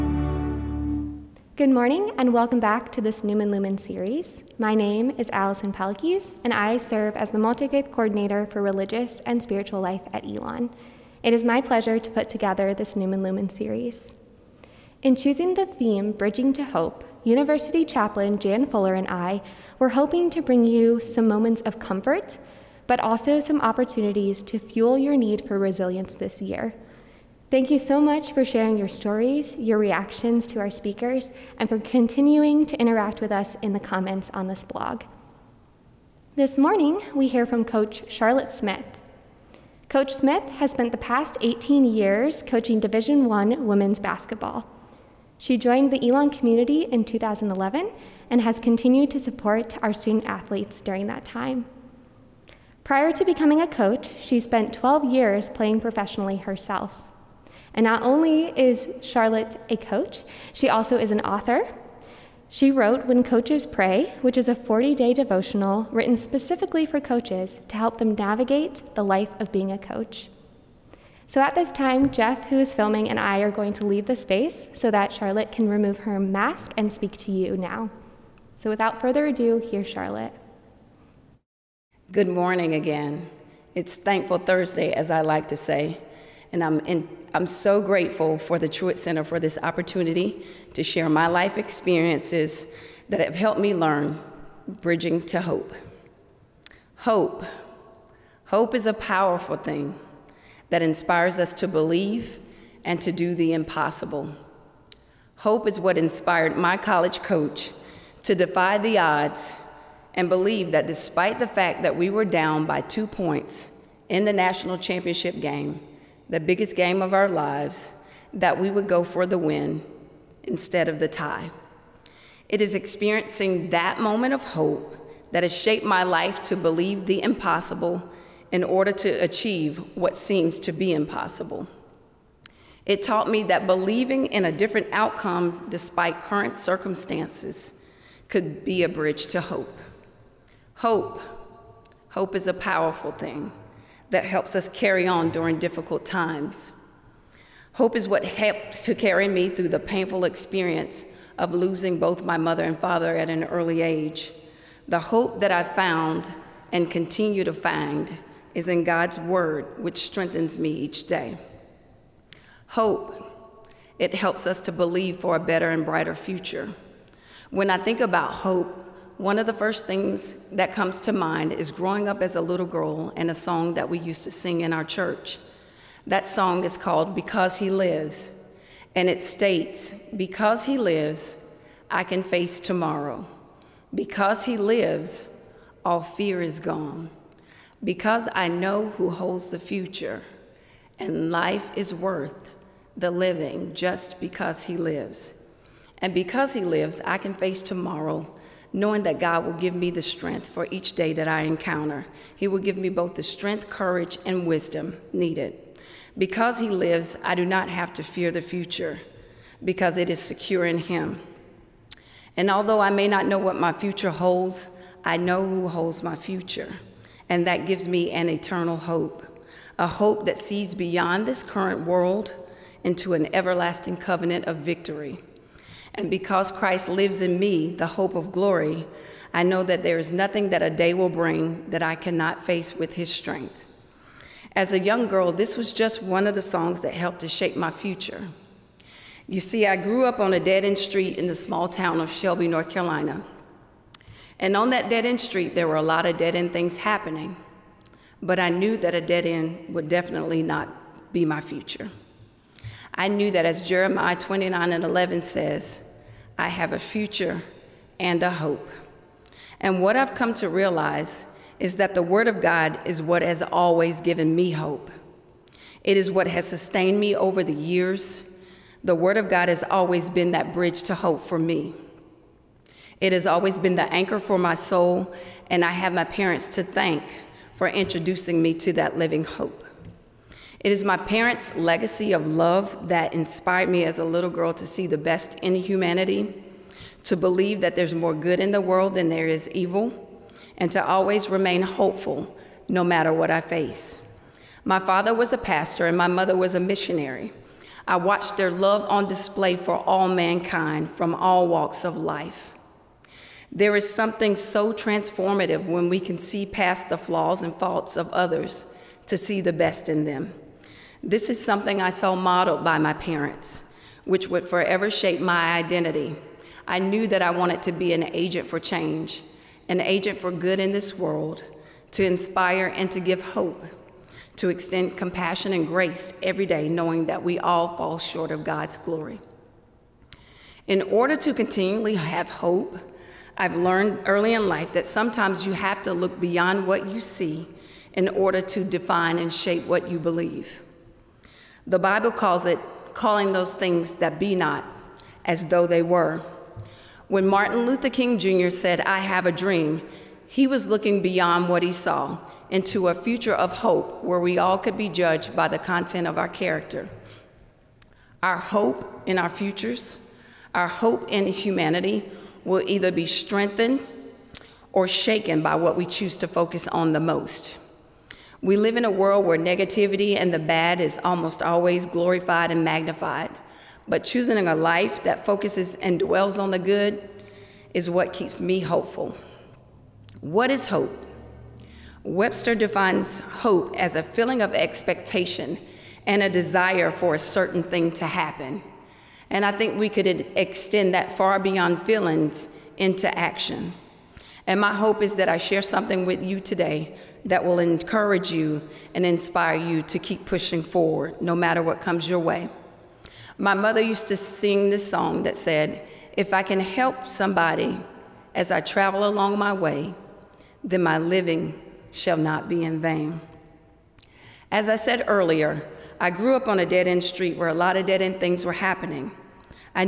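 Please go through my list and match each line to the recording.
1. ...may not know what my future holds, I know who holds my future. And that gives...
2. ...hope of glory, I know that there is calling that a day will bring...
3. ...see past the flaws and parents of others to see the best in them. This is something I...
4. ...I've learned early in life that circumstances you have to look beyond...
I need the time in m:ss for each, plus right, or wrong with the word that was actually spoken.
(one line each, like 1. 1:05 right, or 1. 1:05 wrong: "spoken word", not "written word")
1. 3:32 right
2. 3:47 wrong: "nothing", not "calling"
3. 5:06 wrong: "faults", not "parents"
4. 5:33 wrong: "sometimes", not "circumstances".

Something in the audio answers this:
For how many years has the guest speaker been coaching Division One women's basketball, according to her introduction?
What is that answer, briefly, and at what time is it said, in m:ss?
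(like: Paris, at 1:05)
18, at 0:41.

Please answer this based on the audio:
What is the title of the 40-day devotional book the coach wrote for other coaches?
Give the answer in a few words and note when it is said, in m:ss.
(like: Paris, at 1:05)
When Coaches Pray, at 1:03.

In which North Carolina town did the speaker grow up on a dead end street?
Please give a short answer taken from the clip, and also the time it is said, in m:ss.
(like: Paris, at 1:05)
Shelby, at 4:02.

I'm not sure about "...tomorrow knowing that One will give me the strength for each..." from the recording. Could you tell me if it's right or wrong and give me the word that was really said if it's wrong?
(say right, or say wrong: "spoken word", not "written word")
wrong: "God", not "One".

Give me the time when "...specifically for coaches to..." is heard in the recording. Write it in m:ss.
1:06.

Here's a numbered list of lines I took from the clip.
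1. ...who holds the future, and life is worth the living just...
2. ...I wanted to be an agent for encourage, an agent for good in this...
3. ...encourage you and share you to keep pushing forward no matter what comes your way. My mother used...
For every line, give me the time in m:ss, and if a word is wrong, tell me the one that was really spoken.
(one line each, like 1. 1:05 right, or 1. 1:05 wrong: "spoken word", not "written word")
1. 3:08 right
2. 5:17 wrong: "change", not "encourage"
3. 6:37 wrong: "inspire", not "share".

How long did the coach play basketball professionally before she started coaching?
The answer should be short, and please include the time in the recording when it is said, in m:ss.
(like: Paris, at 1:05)
12 years, at 0:54.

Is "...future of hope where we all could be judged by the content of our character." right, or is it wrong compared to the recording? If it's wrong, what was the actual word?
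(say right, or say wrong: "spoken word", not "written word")
right.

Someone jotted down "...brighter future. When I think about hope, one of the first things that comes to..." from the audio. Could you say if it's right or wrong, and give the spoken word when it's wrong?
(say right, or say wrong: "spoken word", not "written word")
right.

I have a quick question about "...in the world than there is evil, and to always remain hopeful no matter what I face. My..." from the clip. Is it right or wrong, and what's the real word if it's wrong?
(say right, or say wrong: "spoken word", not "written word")
right.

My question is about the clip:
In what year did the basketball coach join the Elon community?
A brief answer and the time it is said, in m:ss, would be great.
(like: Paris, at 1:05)
2011, at 0:47.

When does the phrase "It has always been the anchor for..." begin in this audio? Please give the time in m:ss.
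4:33.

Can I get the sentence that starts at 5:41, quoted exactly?
The Bible calls it calling those things that be not as though they were.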